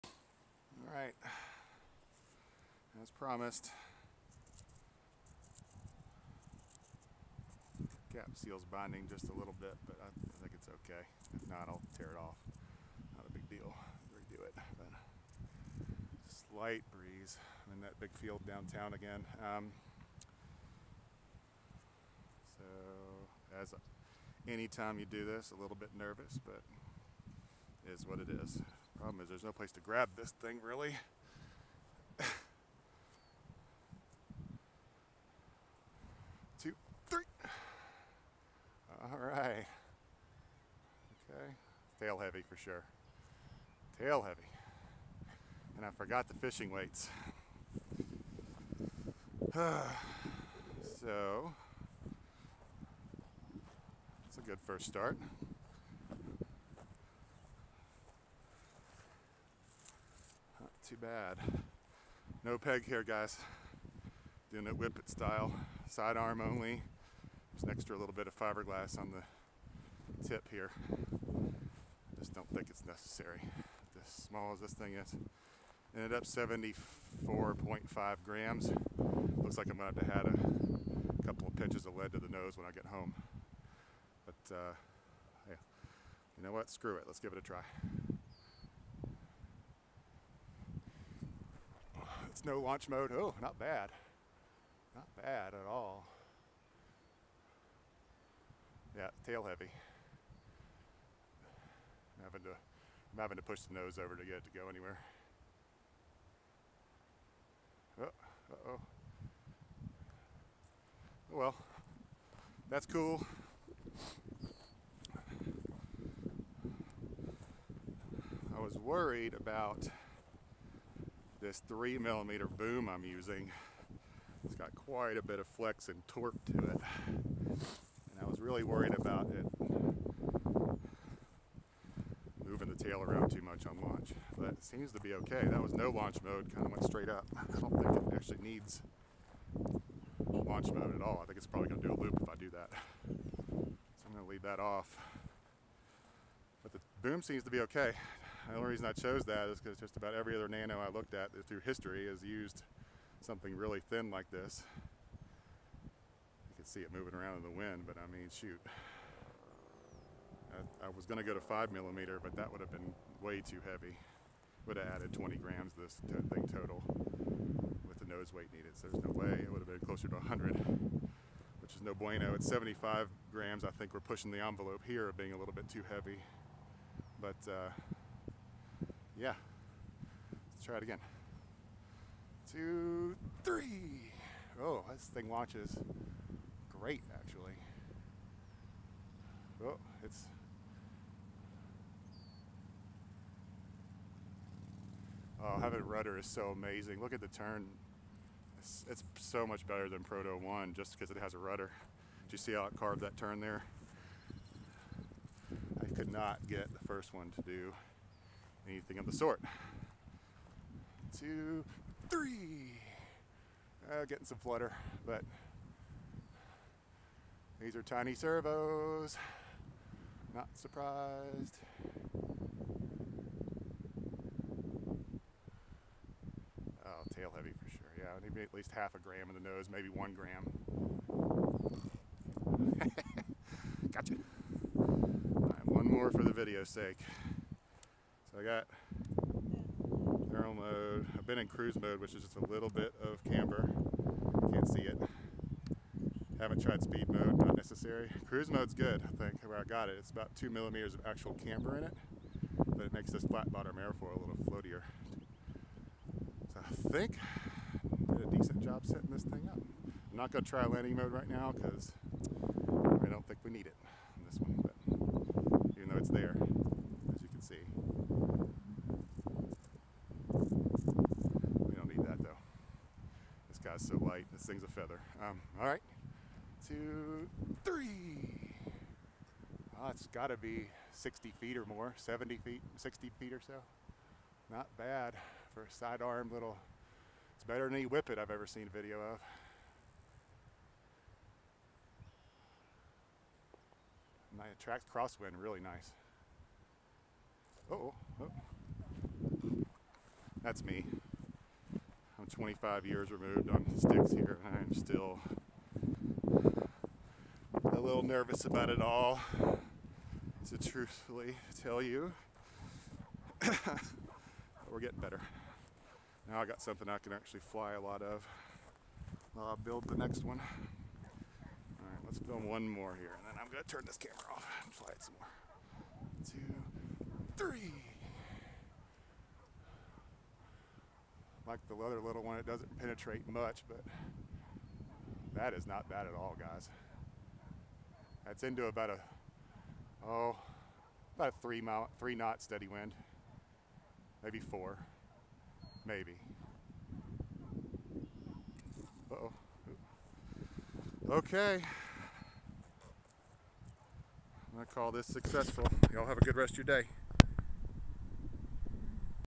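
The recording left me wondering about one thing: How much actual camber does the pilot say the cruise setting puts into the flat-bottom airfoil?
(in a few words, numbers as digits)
2 millimeters.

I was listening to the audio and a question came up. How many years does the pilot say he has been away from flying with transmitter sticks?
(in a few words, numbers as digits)
25 years.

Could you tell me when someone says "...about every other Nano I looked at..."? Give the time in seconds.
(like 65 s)
149 s.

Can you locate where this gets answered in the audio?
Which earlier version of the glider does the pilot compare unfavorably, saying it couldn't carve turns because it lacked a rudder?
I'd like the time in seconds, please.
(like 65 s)
200 s.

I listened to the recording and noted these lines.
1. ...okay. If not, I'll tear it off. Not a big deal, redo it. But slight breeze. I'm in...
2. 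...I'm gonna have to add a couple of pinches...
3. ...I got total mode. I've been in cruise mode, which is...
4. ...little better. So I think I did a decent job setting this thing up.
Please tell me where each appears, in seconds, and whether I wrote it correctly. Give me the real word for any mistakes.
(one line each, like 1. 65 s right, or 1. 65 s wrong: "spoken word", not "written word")
1. 10 s right
2. 79 s right
3. 238 s wrong: "thermal", not "total"
4. 254 s wrong: "floatier", not "better".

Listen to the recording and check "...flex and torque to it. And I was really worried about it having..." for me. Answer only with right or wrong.
wrong.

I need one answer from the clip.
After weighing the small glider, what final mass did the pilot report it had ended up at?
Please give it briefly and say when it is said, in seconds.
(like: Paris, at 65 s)
74.5 grams, at 76 s.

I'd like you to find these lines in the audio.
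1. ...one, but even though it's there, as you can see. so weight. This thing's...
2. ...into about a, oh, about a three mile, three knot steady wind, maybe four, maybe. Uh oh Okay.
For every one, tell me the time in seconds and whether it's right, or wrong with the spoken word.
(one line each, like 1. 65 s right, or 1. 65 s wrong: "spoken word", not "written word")
1. 264 s wrong: "light", not "weight"
2. 338 s right.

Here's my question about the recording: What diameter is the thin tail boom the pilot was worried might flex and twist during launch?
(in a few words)
3 millimeter.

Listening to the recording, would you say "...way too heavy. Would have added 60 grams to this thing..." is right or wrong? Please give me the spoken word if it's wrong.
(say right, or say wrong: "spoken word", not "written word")
wrong: "20", not "60".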